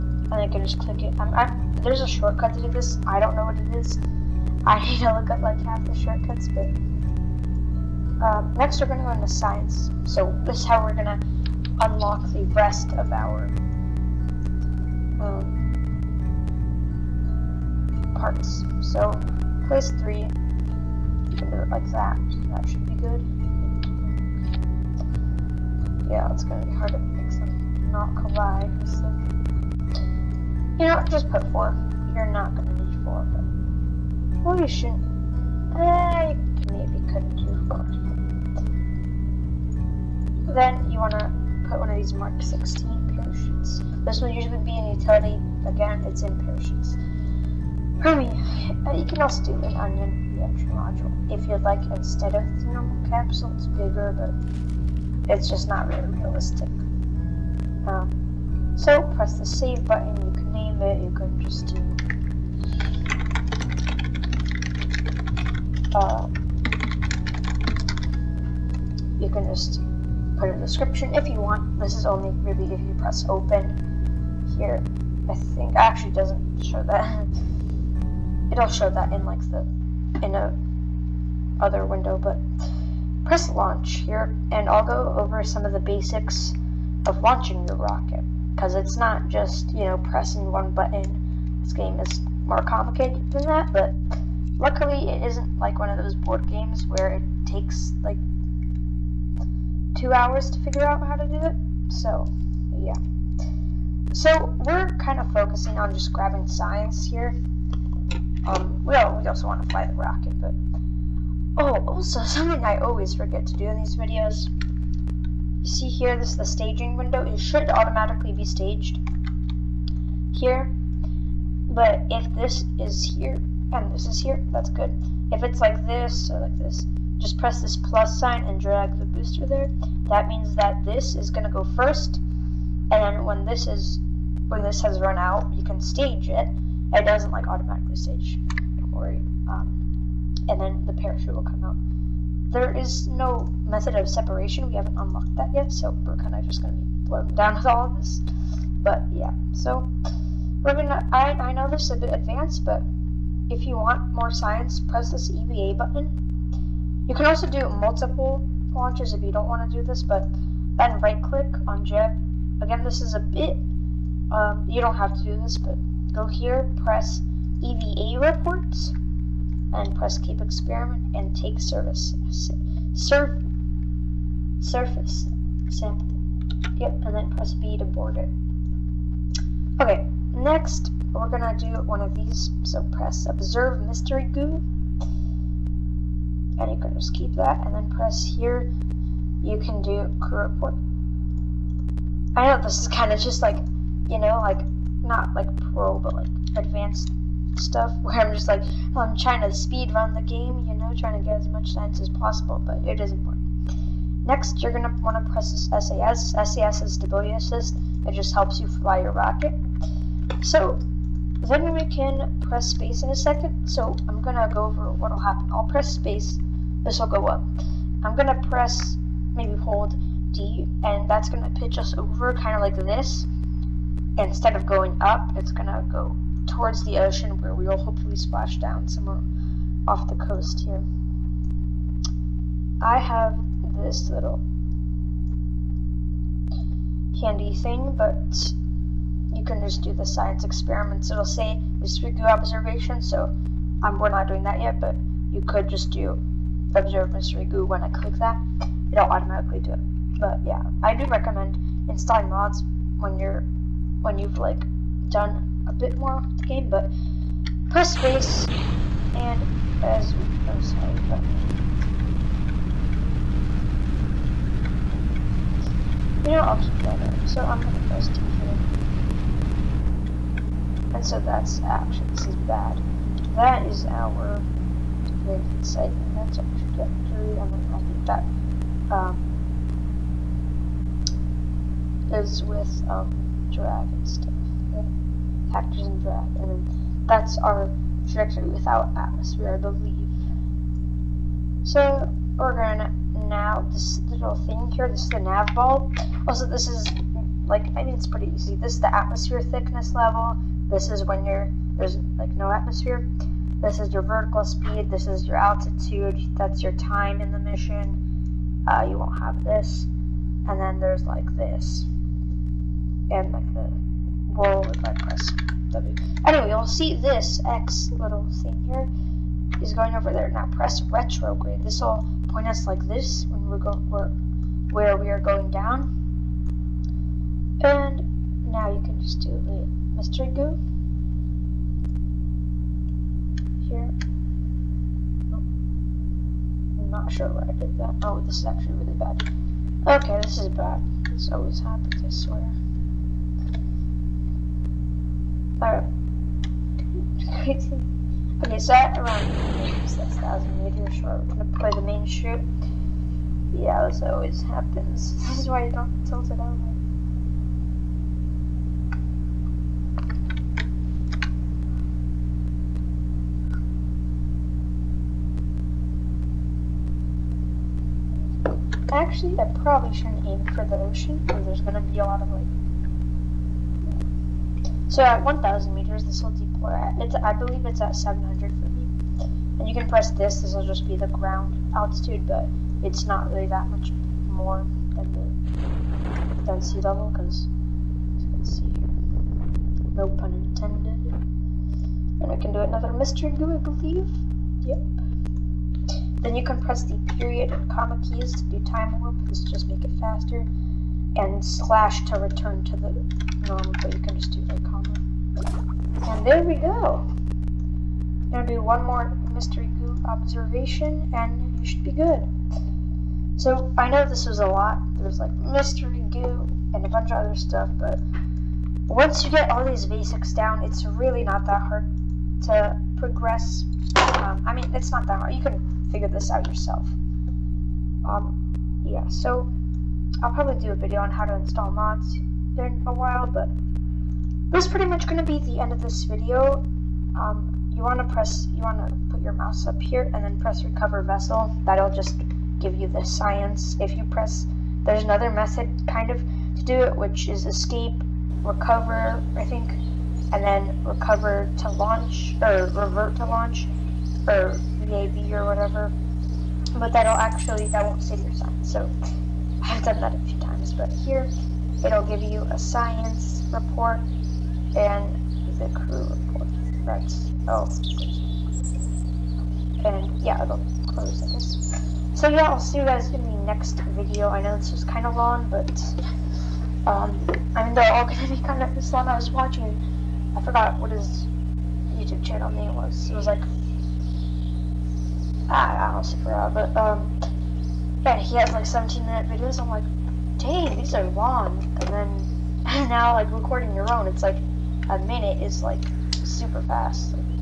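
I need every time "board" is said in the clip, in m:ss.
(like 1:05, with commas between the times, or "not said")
1:36, 2:57.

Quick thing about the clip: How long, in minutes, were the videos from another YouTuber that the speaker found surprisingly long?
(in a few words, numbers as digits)
17 minutes.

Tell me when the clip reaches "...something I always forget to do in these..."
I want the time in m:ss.
1:52.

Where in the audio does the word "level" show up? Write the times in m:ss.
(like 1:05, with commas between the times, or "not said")
4:59, 6:26.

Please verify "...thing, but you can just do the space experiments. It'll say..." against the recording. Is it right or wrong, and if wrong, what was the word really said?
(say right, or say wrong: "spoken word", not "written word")
wrong: "science", not "space".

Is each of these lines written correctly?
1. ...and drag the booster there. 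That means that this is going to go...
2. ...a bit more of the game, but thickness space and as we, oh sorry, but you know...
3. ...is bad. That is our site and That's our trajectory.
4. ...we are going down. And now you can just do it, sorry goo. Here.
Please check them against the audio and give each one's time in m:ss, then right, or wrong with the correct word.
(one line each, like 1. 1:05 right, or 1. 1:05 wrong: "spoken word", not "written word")
1. 2:08 right
2. 4:15 wrong: "press", not "thickness"
3. 4:32 right
4. 5:24 wrong: "mystery", not "sorry".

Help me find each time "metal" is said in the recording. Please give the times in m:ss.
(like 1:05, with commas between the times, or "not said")
not said.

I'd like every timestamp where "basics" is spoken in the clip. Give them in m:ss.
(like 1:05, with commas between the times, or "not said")
1:25, 6:59.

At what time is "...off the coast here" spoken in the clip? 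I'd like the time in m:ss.
3:49.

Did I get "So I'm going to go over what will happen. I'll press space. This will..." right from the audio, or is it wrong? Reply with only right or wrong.
right.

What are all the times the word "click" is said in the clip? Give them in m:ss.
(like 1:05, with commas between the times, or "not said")
0:00, 2:41, 4:07.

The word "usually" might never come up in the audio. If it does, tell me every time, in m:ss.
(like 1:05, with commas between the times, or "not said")
0:44.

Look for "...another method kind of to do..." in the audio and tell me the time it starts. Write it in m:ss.
7:25.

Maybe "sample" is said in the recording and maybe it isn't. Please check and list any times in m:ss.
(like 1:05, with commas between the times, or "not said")
2:55.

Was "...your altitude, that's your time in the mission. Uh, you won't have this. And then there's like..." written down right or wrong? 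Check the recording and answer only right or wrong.
right.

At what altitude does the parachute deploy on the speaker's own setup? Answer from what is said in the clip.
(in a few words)
700.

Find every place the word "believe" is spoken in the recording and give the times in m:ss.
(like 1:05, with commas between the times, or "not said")
4:49, 6:17, 6:33.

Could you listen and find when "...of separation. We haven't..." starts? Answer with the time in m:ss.
2:23.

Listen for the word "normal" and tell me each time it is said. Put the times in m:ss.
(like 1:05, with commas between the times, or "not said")
0:52, 6:43.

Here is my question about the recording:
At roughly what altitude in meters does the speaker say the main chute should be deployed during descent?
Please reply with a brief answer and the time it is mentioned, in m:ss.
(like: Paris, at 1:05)
6,000 meters, at 5:49.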